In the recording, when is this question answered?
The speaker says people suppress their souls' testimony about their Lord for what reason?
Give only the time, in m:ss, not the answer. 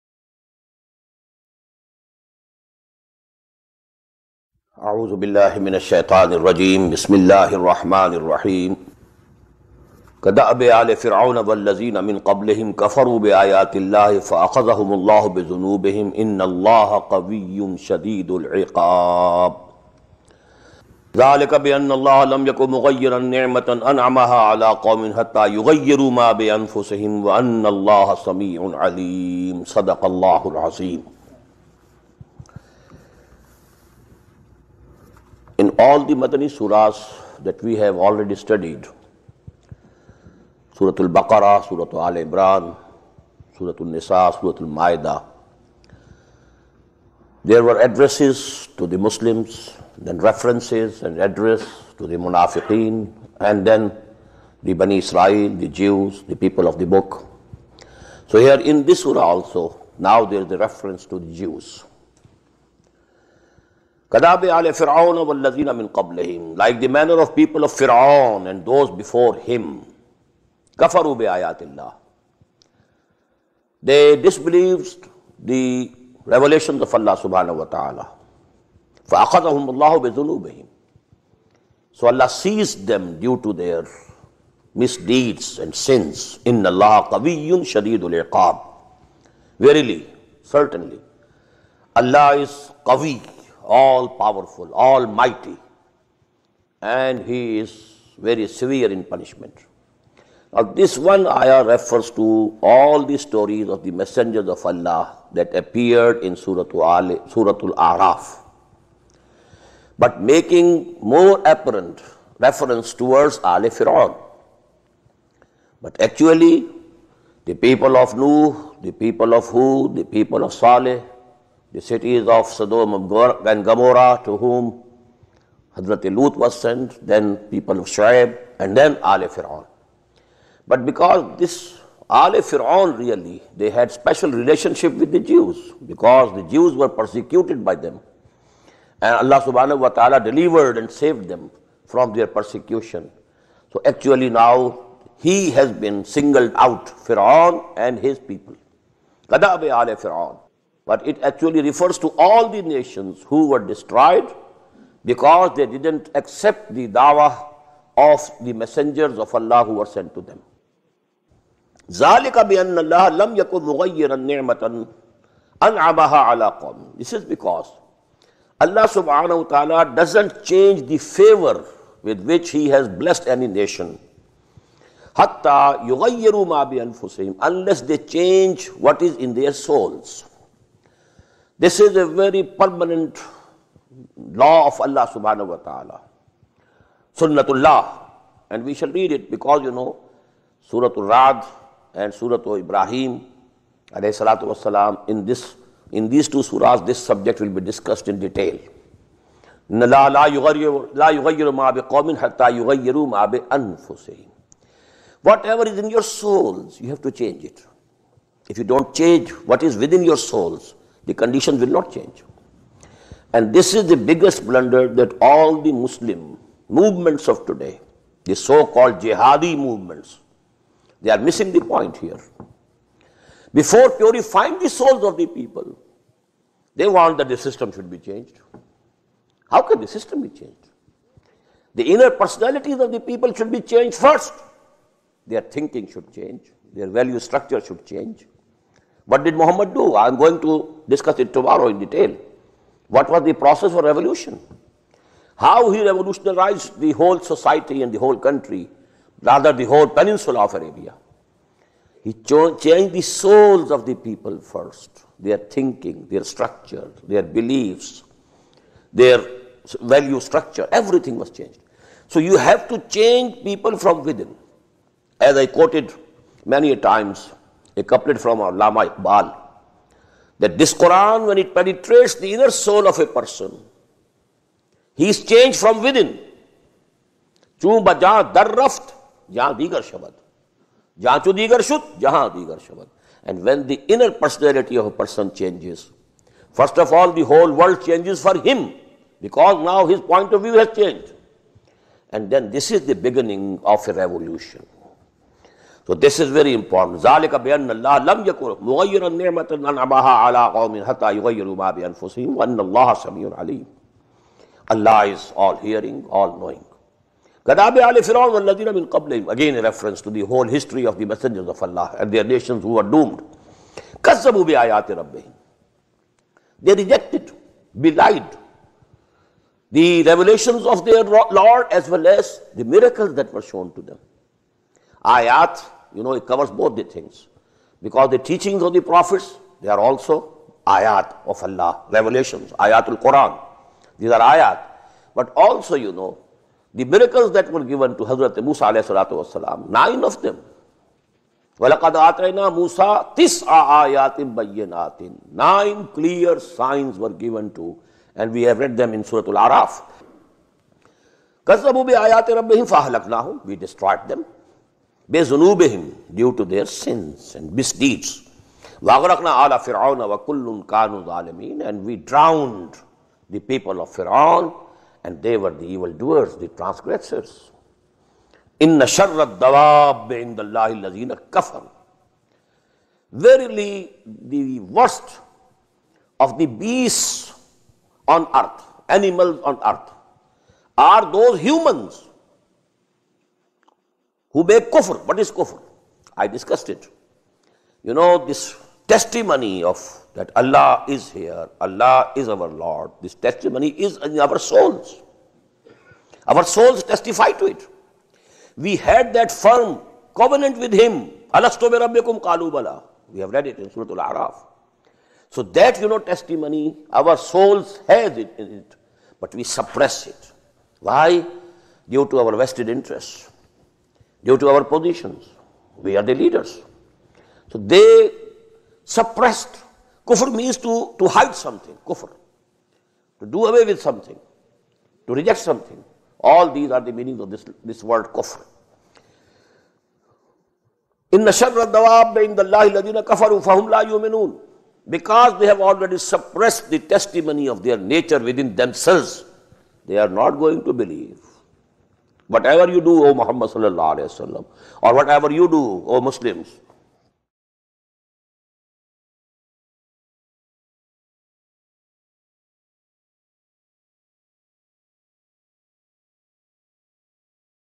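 6:52.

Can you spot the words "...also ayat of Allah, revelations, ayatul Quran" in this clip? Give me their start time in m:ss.
5:29.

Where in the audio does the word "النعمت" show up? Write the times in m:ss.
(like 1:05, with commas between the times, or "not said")
4:59.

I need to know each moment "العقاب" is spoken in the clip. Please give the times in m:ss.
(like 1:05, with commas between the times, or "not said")
0:18, 1:28.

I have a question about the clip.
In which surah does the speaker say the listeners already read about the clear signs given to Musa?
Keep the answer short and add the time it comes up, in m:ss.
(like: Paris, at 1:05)
Surah Al-Araf, at 5:49.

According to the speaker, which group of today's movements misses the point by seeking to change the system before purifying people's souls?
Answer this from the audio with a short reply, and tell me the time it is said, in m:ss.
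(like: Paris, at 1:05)
jihadi movements, at 3:38.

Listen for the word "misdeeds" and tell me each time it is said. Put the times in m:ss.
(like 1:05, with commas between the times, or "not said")
1:24, 5:57.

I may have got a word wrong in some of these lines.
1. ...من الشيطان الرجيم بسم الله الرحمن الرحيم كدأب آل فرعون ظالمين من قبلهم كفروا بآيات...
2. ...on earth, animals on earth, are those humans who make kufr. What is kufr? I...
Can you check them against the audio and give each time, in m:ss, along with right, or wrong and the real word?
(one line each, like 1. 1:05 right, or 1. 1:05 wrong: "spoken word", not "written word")
1. 0:05 wrong: "والذين", not "ظالمين"
2. 6:18 right.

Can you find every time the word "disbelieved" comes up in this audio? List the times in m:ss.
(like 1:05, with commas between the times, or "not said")
1:14.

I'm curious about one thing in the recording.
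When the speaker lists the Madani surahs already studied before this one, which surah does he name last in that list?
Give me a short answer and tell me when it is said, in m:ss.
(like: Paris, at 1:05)
Surah Al-Ma'idah, at 0:44.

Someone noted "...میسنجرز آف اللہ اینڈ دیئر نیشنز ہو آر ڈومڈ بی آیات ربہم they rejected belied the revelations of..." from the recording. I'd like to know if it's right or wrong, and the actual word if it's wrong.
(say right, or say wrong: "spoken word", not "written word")
right.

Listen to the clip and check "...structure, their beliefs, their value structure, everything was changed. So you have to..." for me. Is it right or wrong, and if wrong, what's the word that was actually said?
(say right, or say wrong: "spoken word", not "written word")
right.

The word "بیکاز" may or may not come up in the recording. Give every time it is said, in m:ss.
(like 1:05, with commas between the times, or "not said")
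3:09, 4:49.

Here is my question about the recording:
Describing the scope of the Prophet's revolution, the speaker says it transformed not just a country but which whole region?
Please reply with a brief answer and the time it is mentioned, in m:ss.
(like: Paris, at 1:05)
the whole peninsula of Arabia, at 4:09.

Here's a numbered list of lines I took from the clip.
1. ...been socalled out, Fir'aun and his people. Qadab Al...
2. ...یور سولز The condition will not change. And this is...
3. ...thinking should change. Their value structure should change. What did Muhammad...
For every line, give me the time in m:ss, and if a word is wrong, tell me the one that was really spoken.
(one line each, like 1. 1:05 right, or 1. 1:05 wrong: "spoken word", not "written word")
1. 2:25 wrong: "singled", not "socalled"
2. 3:25 right
3. 3:55 right.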